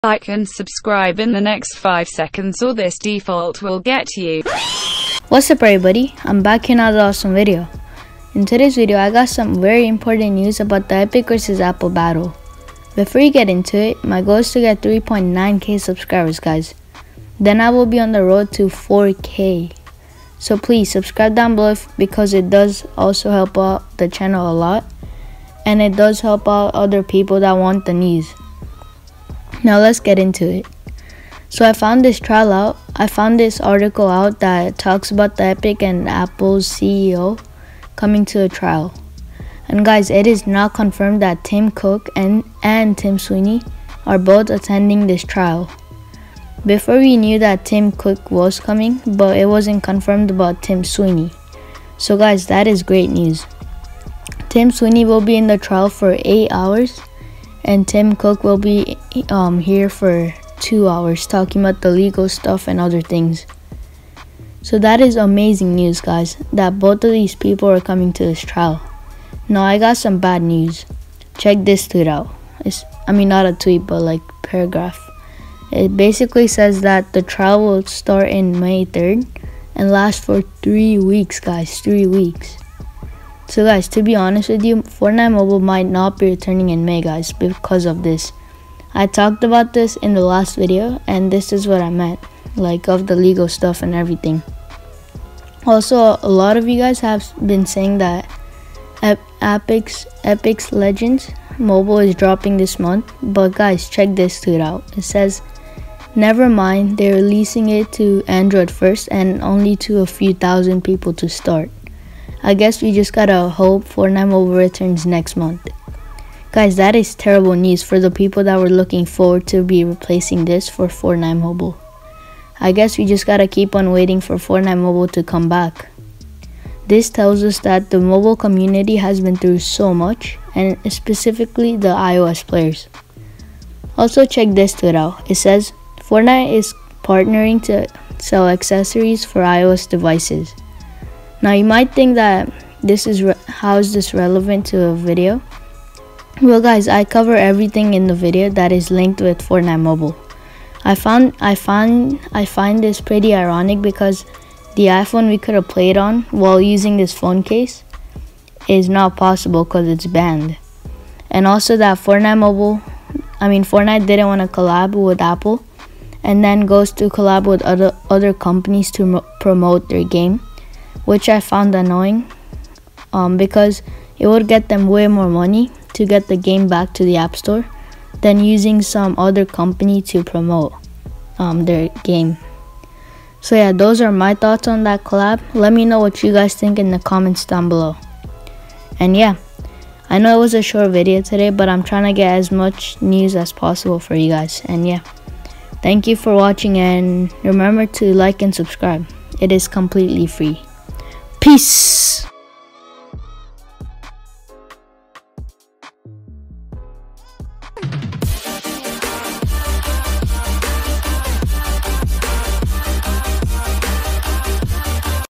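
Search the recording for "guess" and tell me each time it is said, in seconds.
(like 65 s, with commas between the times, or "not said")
112 s, 122 s.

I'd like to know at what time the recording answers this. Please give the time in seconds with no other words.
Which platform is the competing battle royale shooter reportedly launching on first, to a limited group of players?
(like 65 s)
108 s.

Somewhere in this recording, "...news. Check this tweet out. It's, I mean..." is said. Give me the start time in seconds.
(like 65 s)
70 s.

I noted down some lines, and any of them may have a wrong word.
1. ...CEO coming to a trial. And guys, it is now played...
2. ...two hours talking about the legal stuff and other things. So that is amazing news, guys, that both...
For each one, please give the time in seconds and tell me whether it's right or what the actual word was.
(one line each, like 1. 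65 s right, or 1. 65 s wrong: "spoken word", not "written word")
1. 36 s wrong: "confirmed", not "played"
2. 60 s right.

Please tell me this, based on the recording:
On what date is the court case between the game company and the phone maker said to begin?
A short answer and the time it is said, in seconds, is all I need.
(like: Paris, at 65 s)
May 3rd, at 78 s.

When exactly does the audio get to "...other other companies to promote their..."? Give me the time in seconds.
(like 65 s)
167 s.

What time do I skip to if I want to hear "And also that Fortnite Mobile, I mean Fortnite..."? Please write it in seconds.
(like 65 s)
161 s.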